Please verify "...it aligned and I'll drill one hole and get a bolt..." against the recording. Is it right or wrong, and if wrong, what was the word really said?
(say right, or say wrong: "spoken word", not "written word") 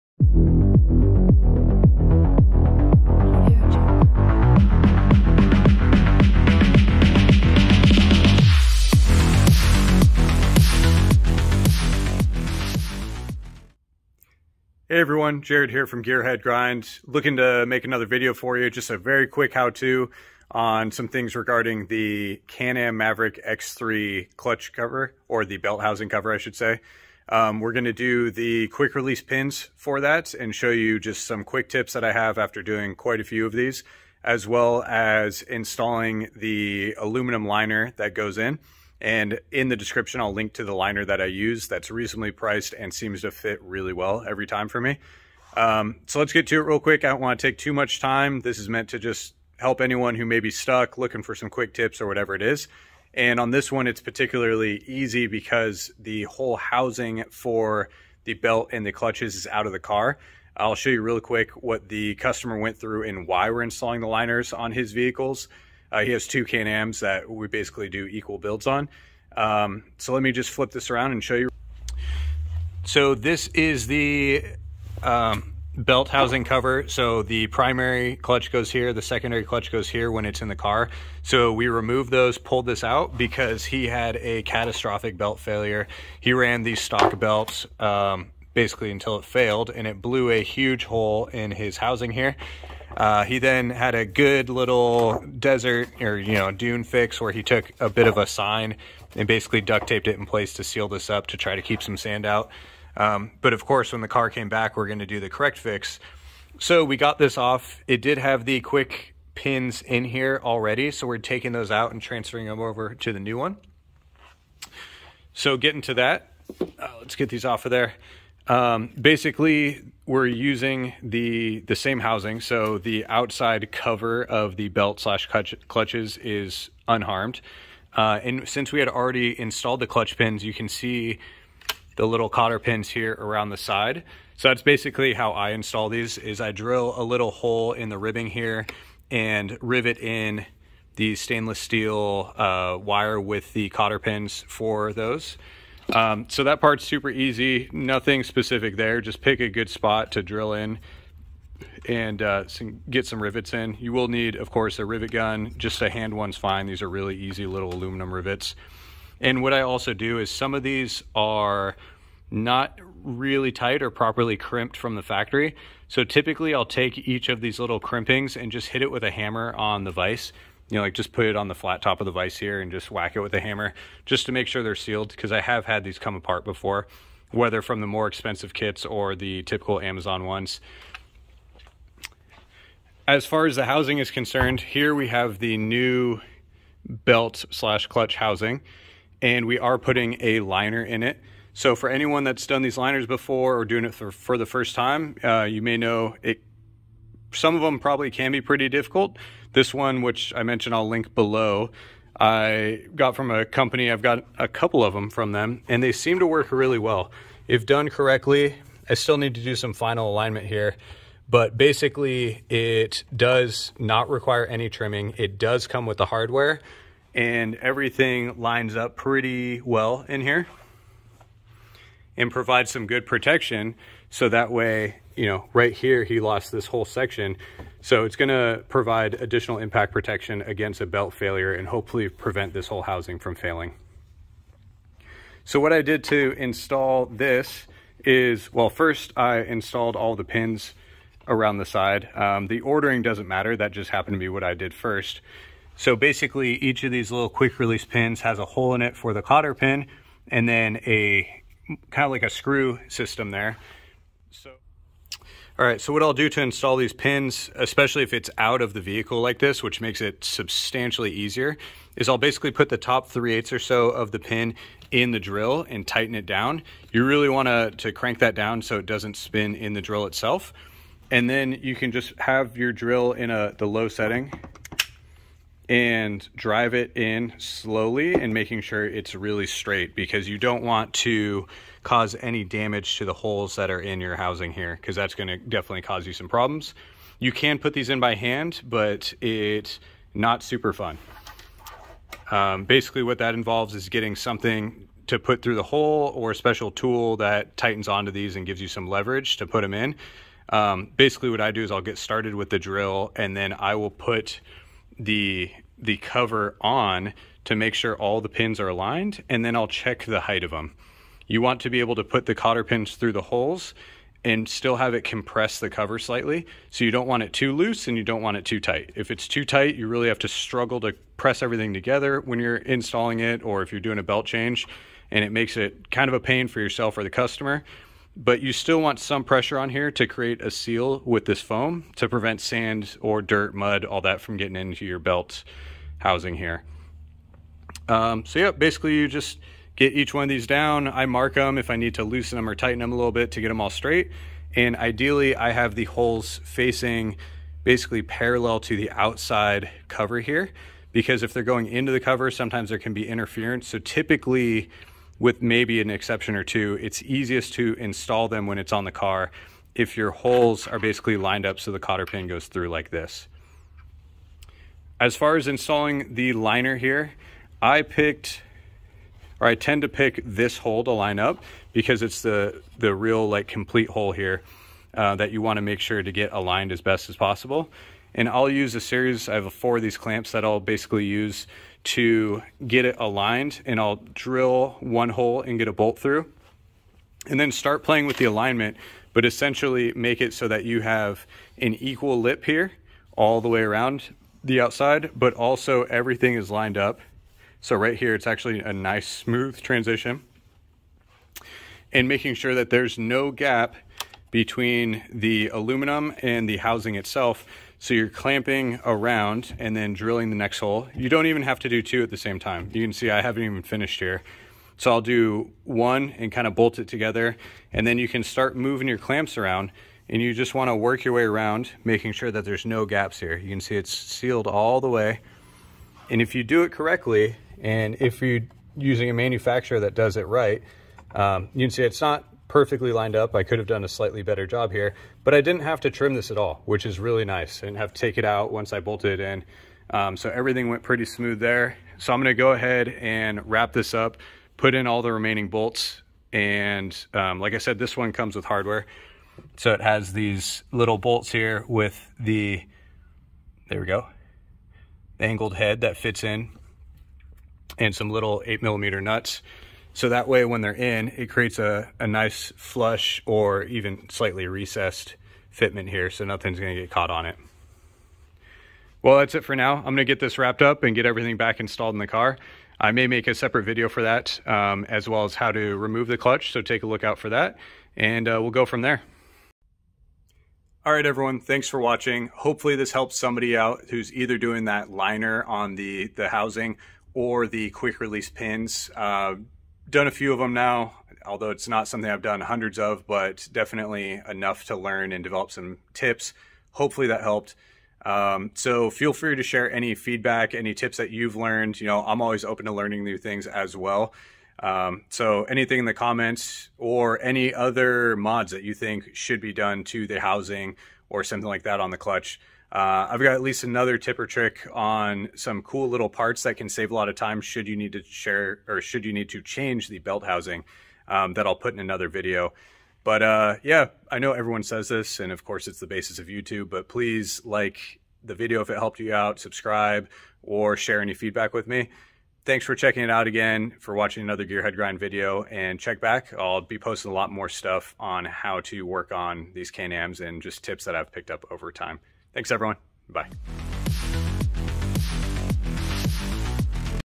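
right.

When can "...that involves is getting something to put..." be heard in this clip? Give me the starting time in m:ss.
4:53.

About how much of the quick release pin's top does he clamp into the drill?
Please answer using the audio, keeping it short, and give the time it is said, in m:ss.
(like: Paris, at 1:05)
3/8, at 4:23.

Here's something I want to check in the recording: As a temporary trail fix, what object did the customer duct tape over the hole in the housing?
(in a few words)
A sign.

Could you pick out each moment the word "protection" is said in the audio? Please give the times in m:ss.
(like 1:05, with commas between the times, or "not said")
3:43, 3:49.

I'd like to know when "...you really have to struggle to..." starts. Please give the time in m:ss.
5:19.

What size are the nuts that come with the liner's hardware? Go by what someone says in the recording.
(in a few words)
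8 millimeter.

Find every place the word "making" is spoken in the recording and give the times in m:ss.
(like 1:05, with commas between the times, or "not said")
4:38, 6:42, 7:01.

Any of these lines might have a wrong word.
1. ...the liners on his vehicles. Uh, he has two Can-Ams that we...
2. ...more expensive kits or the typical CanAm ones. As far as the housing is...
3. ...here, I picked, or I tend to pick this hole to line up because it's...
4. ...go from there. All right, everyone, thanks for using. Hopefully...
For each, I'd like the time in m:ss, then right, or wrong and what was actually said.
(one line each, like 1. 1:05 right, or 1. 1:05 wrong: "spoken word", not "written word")
1. 1:04 right
2. 2:57 wrong: "Amazon", not "CanAm"
3. 6:06 right
4. 7:58 wrong: "watching", not "using".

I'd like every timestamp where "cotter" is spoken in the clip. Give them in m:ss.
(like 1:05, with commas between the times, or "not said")
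2:12, 2:23, 4:09, 5:12, 6:01.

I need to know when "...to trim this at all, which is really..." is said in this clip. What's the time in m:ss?
7:15.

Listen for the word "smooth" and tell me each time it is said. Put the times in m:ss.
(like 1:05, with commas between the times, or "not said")
6:39, 7:21.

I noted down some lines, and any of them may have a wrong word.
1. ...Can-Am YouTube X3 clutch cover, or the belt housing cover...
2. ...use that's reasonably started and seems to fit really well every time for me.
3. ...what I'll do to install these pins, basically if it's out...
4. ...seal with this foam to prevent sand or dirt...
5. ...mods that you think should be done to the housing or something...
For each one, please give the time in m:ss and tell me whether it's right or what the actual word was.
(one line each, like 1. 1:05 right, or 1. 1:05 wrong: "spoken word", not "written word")
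1. 0:22 wrong: "Maverick", not "YouTube"
2. 0:41 wrong: "priced", not "started"
3. 4:15 wrong: "especially", not "basically"
4. 5:30 right
5. 8:28 right.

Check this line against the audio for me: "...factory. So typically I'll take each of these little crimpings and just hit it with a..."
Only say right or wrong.
right.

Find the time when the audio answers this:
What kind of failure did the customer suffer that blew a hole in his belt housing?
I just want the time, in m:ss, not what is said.
1:24.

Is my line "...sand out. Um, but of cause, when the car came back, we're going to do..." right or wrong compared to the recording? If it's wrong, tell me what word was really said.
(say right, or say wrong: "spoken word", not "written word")
wrong: "course", not "cause".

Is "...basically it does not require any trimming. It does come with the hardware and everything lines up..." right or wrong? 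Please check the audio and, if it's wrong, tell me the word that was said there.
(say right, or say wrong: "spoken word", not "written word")
right.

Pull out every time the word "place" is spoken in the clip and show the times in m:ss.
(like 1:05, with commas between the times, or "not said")
1:40.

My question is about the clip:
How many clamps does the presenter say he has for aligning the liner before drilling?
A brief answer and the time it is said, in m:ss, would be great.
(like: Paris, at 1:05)
4, at 6:19.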